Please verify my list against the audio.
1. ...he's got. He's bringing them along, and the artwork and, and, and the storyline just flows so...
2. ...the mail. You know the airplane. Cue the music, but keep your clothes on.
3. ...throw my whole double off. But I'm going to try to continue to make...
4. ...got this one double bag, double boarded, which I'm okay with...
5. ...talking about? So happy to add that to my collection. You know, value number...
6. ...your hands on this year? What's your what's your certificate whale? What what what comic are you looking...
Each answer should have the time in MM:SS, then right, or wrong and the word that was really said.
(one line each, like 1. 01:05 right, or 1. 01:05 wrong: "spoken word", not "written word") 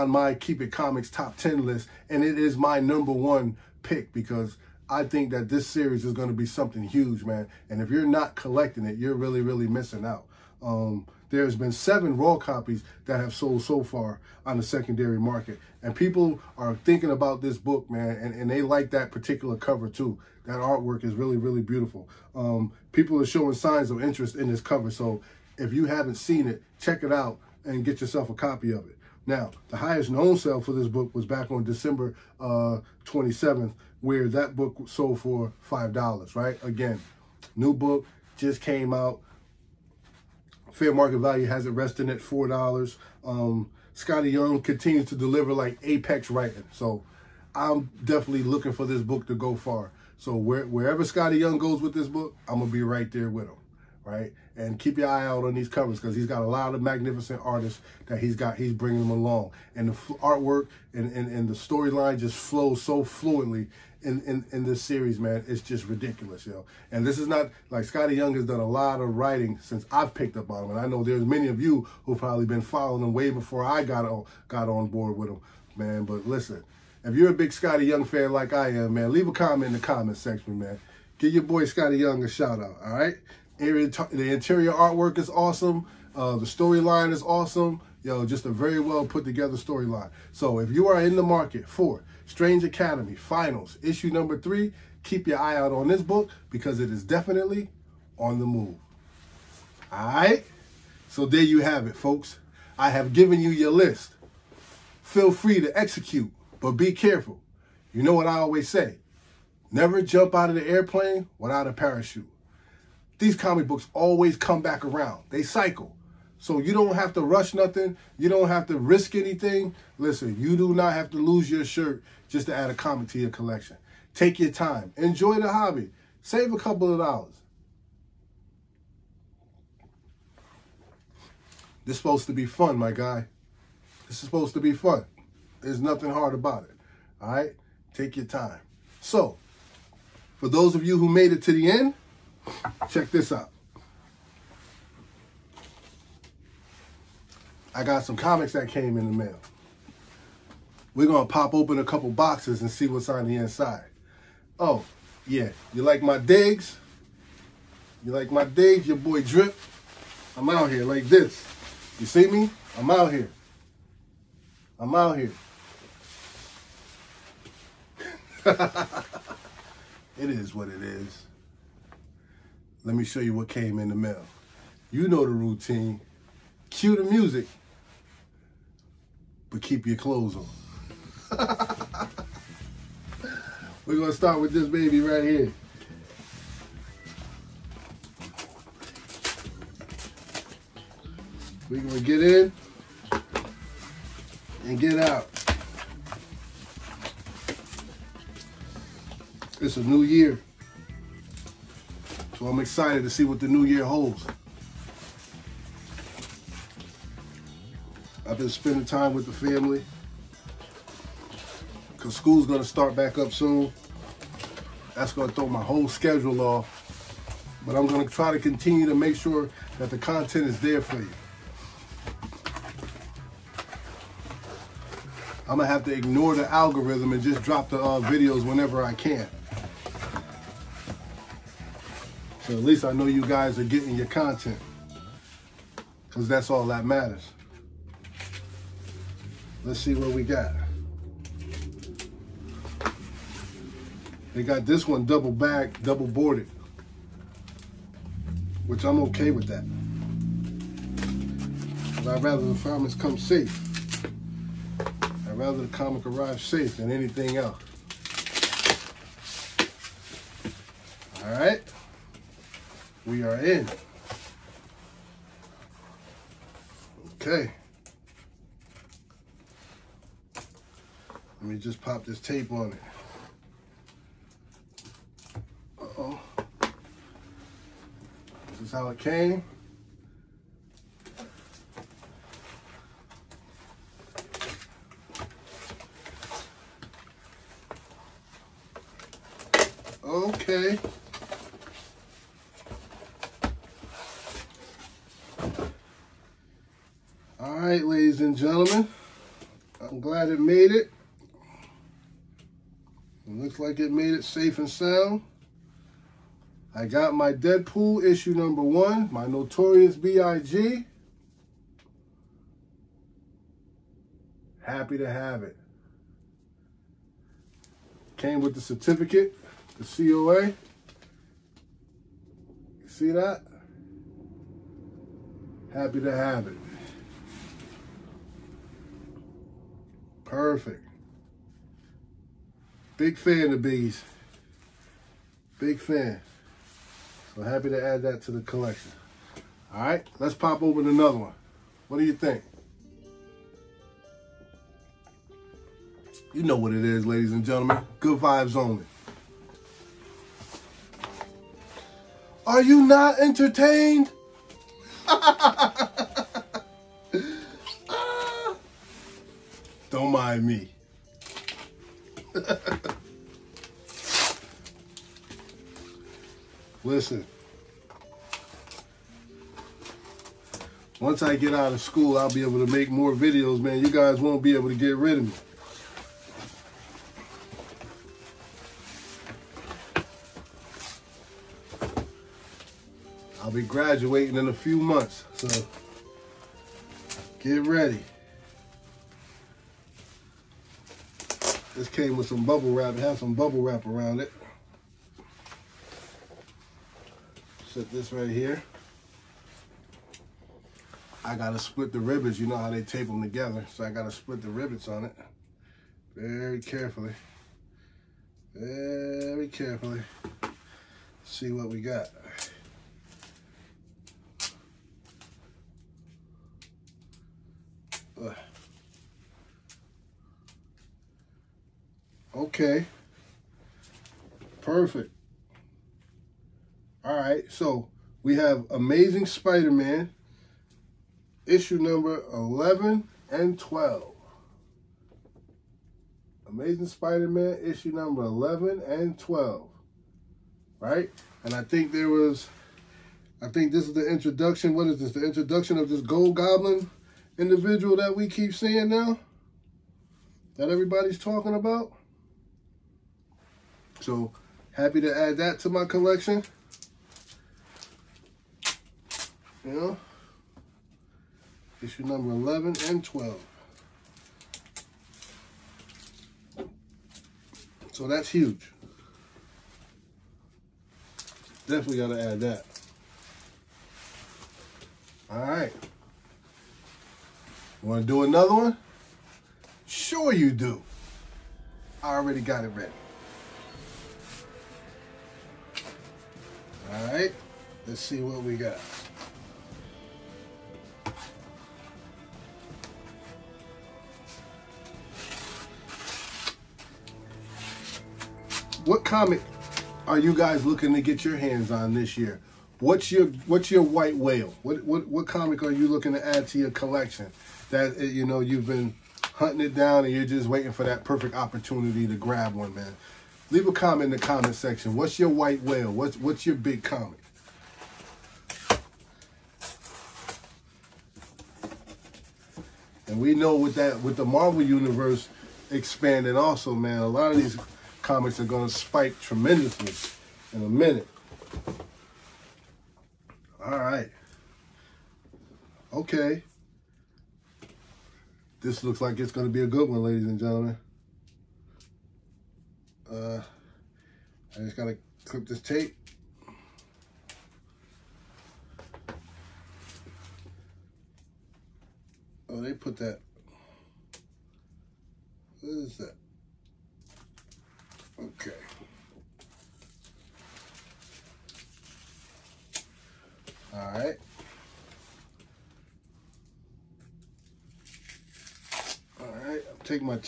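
1. 00:58 right
2. 02:53 wrong: "routine", not "airplane"
3. 03:35 wrong: "schedule", not "double"
4. 04:04 right
5. 07:31 wrong: "issue", not "value"
6. 08:21 wrong: "white", not "certificate".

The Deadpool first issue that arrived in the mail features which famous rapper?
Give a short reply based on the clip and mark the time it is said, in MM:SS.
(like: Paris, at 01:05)
Notorious B.I.G., at 05:09.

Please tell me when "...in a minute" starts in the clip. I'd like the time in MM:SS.
08:50.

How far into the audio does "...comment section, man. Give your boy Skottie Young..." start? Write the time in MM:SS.
01:19.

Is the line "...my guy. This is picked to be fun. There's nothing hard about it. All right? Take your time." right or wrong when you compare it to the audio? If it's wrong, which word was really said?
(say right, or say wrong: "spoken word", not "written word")
wrong: "supposed", not "picked".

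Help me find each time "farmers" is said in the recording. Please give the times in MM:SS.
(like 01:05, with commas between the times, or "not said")
04:12.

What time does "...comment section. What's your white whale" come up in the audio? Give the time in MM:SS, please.
08:34.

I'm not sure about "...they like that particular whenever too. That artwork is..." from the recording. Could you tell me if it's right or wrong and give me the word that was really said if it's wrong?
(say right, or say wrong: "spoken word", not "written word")
wrong: "cover", not "whenever".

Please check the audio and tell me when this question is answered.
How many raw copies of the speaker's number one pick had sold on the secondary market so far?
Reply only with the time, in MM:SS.
00:11.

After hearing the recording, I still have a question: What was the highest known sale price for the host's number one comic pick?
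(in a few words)
$5.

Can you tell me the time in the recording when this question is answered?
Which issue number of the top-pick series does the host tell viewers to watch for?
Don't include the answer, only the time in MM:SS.
01:34.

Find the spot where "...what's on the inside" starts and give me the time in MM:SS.
02:32.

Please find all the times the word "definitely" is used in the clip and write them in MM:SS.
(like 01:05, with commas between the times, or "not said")
00:48, 01:37, 07:51.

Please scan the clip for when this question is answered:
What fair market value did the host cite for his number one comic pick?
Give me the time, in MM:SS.
00:42.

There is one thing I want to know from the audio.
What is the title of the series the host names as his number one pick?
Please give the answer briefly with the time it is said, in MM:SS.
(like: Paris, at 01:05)
Strange Academy Finals, at 01:32.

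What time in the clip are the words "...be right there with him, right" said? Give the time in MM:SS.
00:52.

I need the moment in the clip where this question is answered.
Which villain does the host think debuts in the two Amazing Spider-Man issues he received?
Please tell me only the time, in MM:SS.
07:26.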